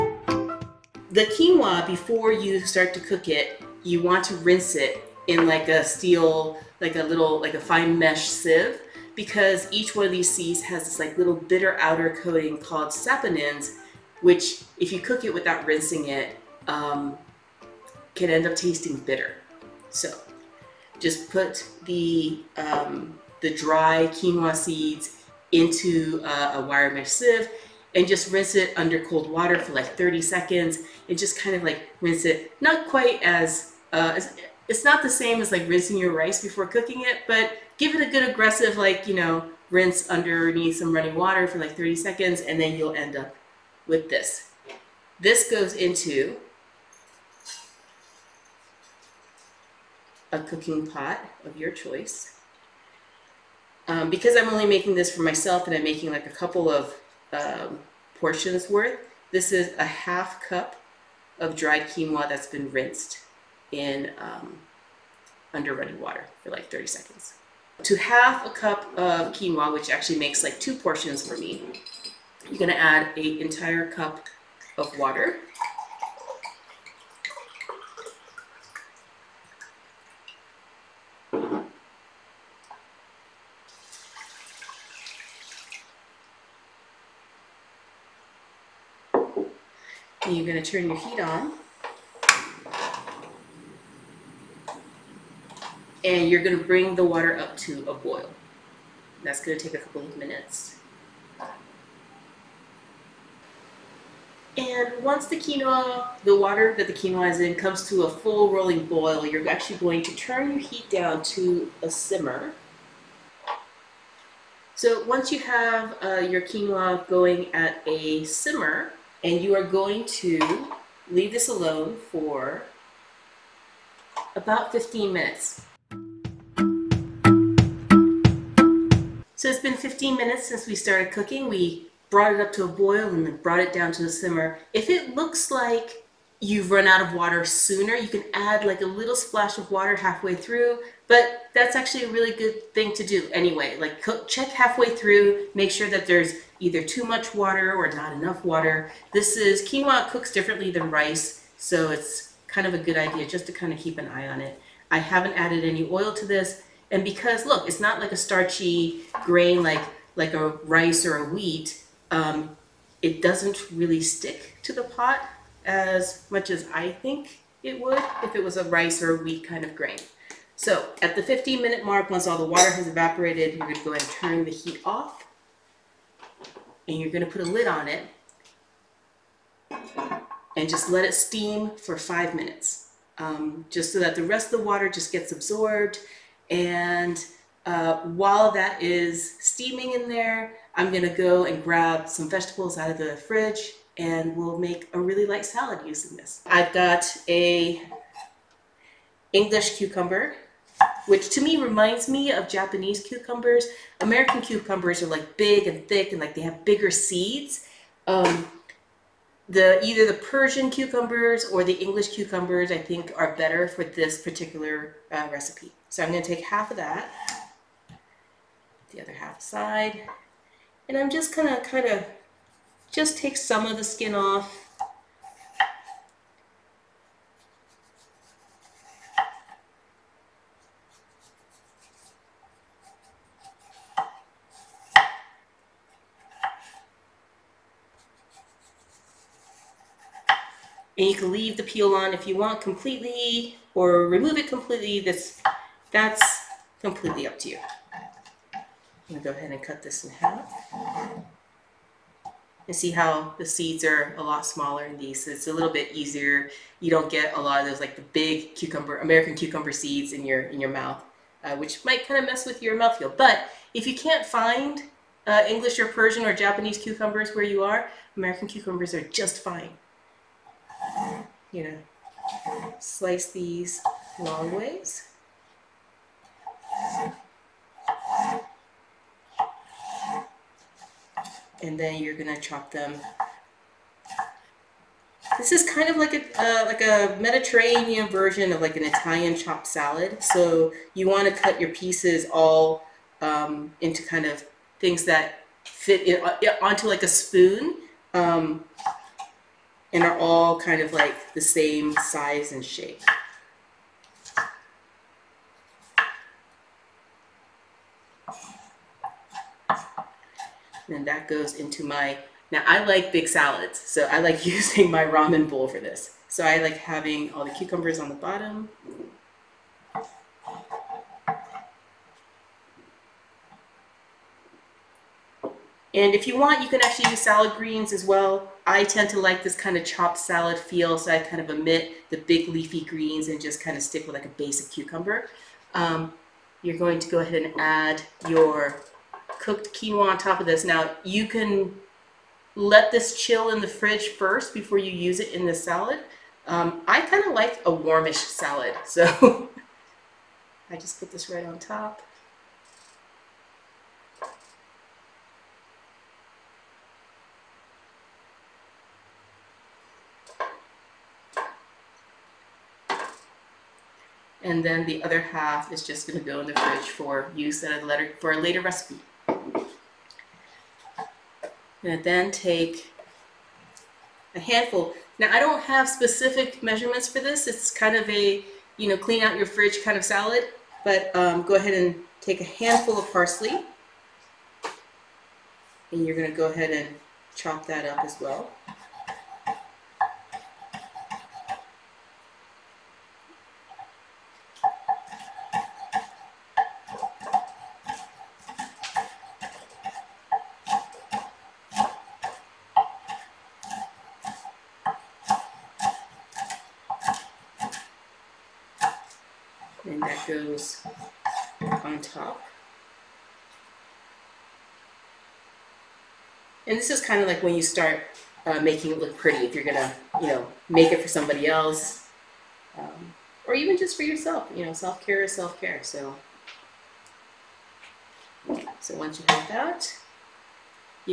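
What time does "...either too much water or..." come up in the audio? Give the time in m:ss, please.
2:26.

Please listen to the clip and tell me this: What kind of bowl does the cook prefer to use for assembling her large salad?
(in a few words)
ramen bowl.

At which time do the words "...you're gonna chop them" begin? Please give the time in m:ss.
4:42.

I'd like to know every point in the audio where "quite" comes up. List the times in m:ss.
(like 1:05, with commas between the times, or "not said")
0:32.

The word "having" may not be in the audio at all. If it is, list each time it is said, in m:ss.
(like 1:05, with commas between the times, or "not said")
5:16.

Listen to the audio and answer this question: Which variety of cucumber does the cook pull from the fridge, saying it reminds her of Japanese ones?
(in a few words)
English cucumber.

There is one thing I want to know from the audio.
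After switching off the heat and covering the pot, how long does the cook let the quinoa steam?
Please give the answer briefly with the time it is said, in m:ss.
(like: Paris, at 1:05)
5 minutes, at 3:01.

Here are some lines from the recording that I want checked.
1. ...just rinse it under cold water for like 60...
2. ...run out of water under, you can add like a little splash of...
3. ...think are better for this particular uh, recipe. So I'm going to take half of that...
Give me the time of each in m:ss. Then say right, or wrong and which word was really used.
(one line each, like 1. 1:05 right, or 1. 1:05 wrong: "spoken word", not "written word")
1. 0:28 wrong: "30", not "60"
2. 2:16 wrong: "sooner", not "under"
3. 3:32 right.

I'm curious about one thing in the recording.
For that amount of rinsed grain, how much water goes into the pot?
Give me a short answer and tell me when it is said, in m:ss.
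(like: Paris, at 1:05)
1 cup, at 1:13.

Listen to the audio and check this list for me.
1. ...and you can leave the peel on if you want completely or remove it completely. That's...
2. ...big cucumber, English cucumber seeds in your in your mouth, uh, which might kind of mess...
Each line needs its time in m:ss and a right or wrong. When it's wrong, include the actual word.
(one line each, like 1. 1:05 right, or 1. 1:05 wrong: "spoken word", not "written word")
1. 4:01 right
2. 4:18 wrong: "American", not "English".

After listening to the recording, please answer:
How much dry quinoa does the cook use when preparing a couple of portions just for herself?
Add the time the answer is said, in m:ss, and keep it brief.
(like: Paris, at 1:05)
half cup, at 0:59.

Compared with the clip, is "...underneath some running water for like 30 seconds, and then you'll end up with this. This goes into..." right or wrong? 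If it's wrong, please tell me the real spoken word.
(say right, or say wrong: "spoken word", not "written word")
right.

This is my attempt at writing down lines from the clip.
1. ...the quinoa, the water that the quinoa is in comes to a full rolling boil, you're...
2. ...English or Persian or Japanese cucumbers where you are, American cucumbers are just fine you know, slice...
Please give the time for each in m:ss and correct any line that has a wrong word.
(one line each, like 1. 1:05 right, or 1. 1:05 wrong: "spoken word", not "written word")
1. 1:45 right
2. 4:25 right.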